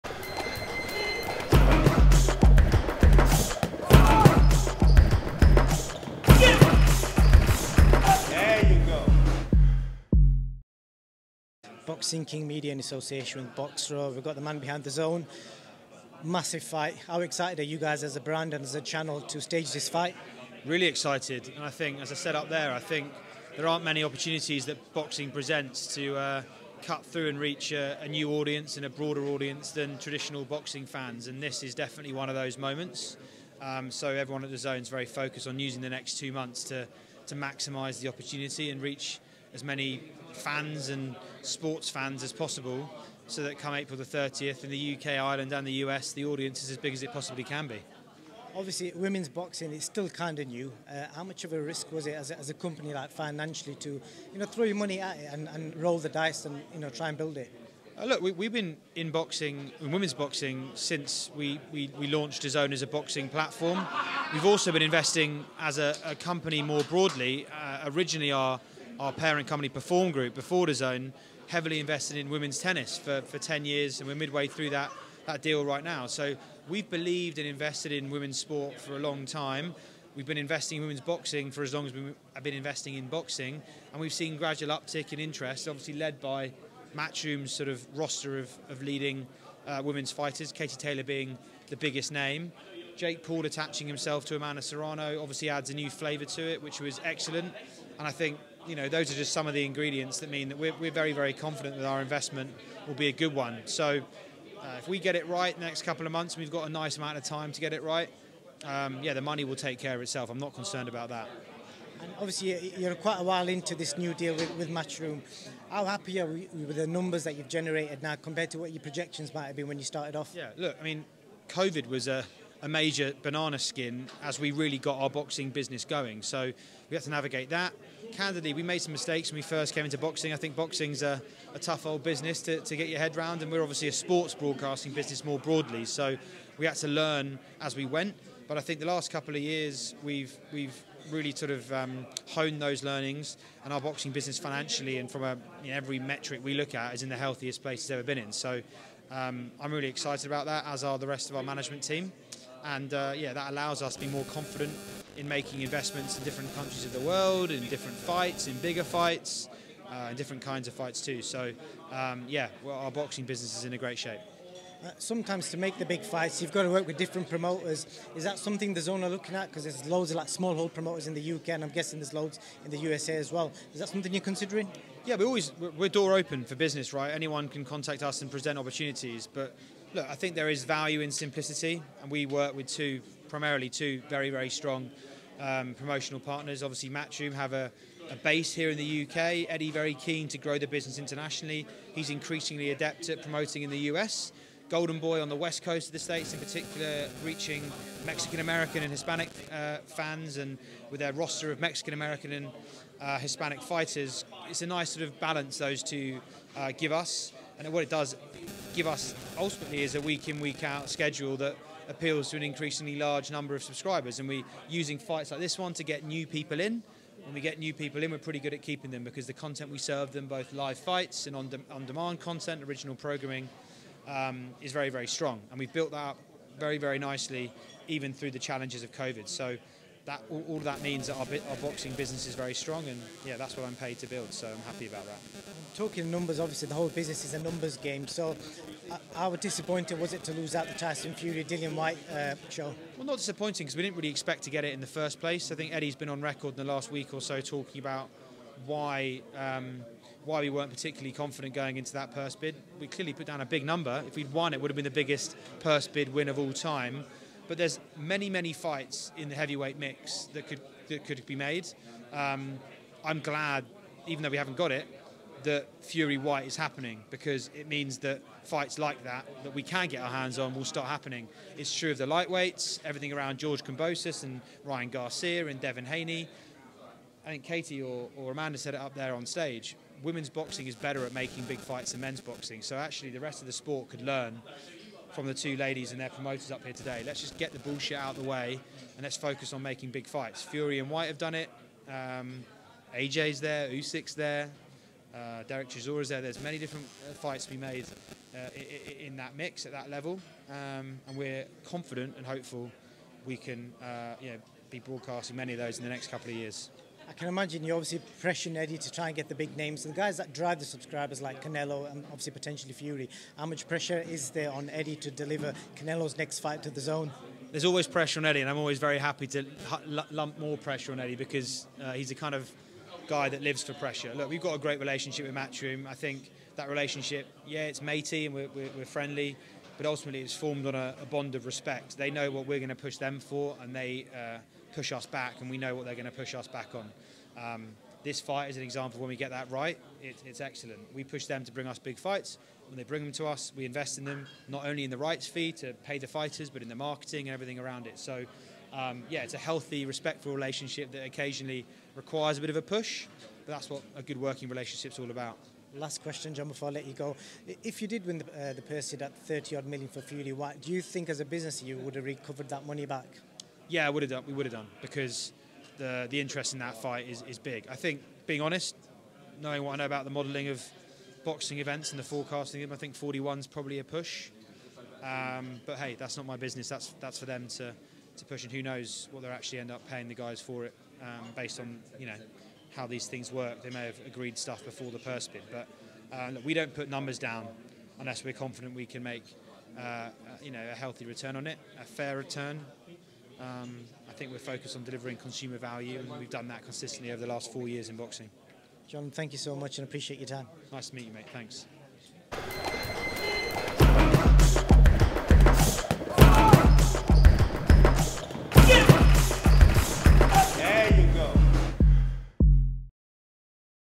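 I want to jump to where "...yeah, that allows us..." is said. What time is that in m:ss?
2:33.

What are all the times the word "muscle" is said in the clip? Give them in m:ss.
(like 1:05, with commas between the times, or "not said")
not said.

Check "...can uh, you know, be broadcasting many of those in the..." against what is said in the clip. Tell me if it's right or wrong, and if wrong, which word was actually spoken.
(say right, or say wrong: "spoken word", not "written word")
right.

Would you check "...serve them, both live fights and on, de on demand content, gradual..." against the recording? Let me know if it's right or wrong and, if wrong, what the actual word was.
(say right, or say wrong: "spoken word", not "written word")
wrong: "original", not "gradual".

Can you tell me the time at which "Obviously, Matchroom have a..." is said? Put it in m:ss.
3:06.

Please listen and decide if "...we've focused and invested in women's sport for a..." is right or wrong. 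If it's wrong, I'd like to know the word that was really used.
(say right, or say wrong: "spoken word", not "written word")
wrong: "believed", not "focused".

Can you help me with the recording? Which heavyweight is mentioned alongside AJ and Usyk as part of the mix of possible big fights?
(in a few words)
Derek Chisora.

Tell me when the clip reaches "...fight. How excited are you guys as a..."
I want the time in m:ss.
0:16.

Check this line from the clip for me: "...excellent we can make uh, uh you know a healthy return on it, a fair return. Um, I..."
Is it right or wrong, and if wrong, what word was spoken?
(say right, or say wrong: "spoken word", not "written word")
wrong: "confident", not "excellent".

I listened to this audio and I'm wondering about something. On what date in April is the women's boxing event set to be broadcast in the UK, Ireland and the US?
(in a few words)
April 30.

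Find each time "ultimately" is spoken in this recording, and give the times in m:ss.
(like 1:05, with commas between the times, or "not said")
3:29, 5:29.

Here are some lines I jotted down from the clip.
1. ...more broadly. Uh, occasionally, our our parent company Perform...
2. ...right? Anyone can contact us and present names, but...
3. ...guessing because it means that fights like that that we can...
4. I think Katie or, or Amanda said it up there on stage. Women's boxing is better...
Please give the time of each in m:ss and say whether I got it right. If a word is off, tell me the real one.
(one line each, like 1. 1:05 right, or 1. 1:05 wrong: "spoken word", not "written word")
1. 1:06 wrong: "originally", not "occasionally"
2. 2:56 wrong: "opportunities", not "names"
3. 4:26 wrong: "happening", not "guessing"
4. 4:37 right.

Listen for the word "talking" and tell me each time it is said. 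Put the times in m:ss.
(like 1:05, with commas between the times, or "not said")
3:55, 4:07.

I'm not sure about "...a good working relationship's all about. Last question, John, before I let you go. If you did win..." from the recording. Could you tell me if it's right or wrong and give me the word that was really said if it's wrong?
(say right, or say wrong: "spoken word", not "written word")
right.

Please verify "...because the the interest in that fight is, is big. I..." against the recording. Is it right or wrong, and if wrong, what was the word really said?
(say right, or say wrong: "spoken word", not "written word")
right.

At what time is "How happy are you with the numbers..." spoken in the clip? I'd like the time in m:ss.
1:55.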